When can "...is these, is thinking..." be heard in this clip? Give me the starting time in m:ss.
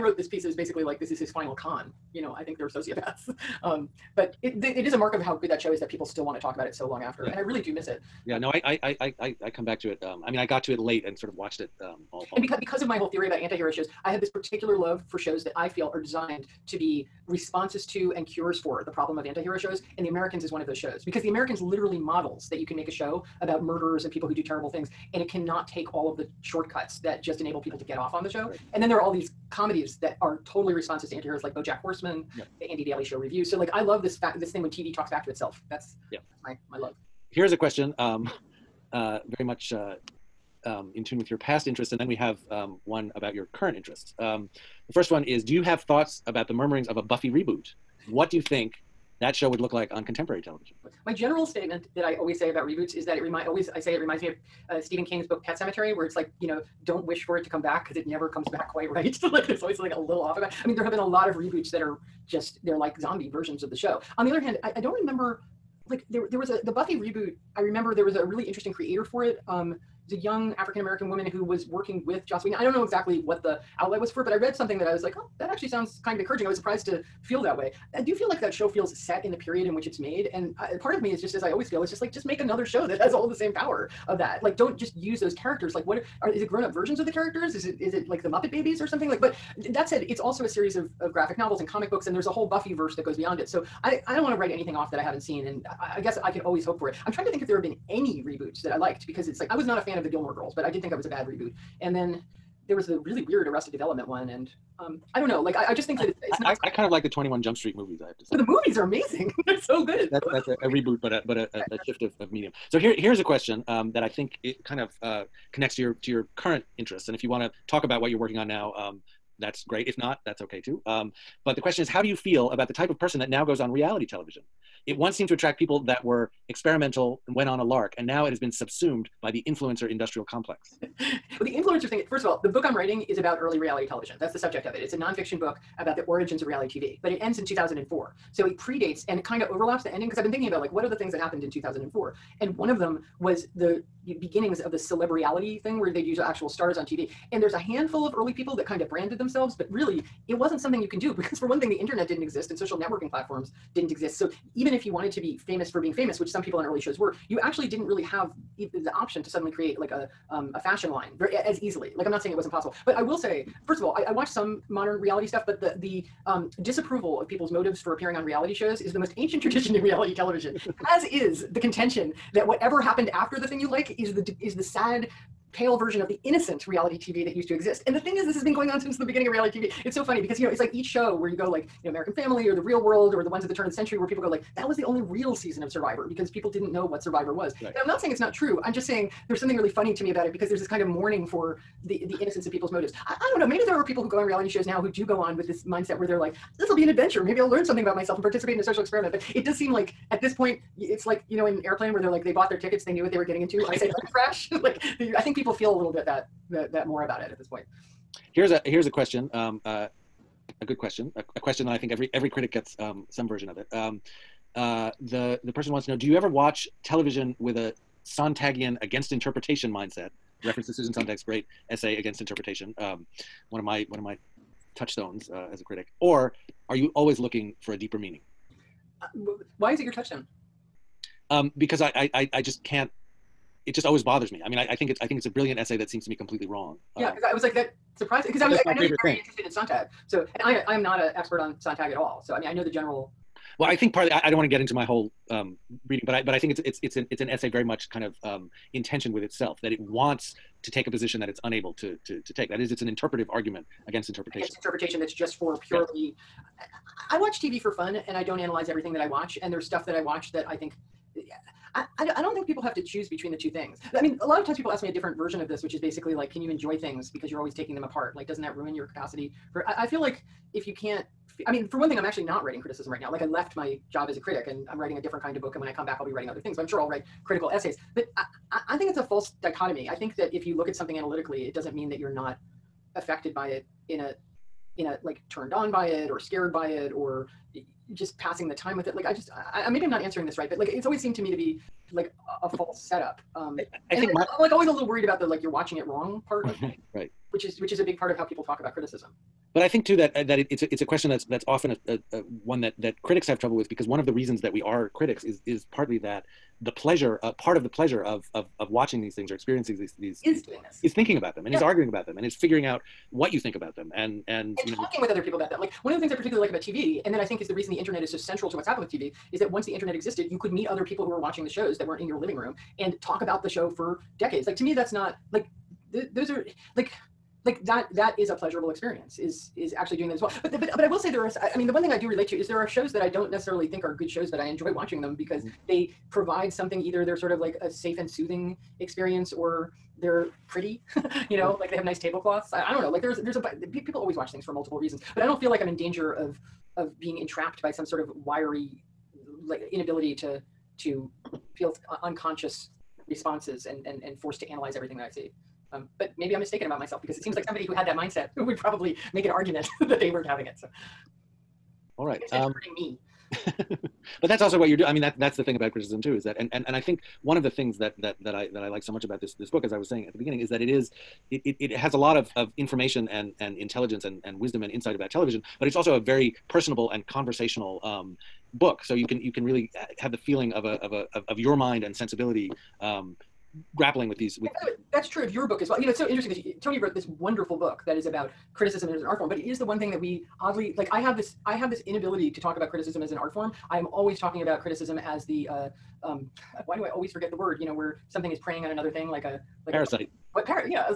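5:10.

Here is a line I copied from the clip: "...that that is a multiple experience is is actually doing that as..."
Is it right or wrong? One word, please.
wrong.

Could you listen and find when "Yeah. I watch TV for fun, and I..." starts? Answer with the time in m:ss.
4:16.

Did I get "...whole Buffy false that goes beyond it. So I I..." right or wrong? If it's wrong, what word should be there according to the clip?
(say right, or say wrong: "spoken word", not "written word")
wrong: "verse", not "false".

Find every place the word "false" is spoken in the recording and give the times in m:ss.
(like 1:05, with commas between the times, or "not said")
4:39, 4:52.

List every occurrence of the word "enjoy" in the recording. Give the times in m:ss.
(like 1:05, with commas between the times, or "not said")
4:26, 5:34.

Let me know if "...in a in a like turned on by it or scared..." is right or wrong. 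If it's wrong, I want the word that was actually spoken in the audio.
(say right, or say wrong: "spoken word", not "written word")
right.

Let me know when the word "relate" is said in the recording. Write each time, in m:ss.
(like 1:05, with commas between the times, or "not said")
5:32.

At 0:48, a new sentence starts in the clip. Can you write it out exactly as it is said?
What do you think that show would look like on contemporary television?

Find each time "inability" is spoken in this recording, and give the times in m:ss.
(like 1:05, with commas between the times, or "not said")
5:49, 6:31.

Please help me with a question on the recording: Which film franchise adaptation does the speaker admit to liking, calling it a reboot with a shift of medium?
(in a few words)
Twenty One Jump Street.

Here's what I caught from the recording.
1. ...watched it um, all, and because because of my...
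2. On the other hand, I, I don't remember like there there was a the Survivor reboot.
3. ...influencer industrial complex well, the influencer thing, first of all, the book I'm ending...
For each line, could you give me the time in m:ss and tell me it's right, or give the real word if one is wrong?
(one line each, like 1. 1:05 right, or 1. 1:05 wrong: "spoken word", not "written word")
1. 0:11 right
2. 1:04 wrong: "Buffy", not "Survivor"
3. 2:09 wrong: "writing", not "ending".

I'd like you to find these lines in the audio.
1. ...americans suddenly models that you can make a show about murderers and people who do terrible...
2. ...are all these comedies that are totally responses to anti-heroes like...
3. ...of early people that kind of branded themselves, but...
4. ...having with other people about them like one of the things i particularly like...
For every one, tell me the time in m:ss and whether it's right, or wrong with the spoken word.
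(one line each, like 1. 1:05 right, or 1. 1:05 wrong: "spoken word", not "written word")
1. 0:21 wrong: "literally", not "suddenly"
2. 0:28 right
3. 2:28 right
4. 5:14 wrong: "talking", not "having".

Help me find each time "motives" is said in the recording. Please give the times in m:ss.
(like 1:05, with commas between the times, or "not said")
2:47, 3:12.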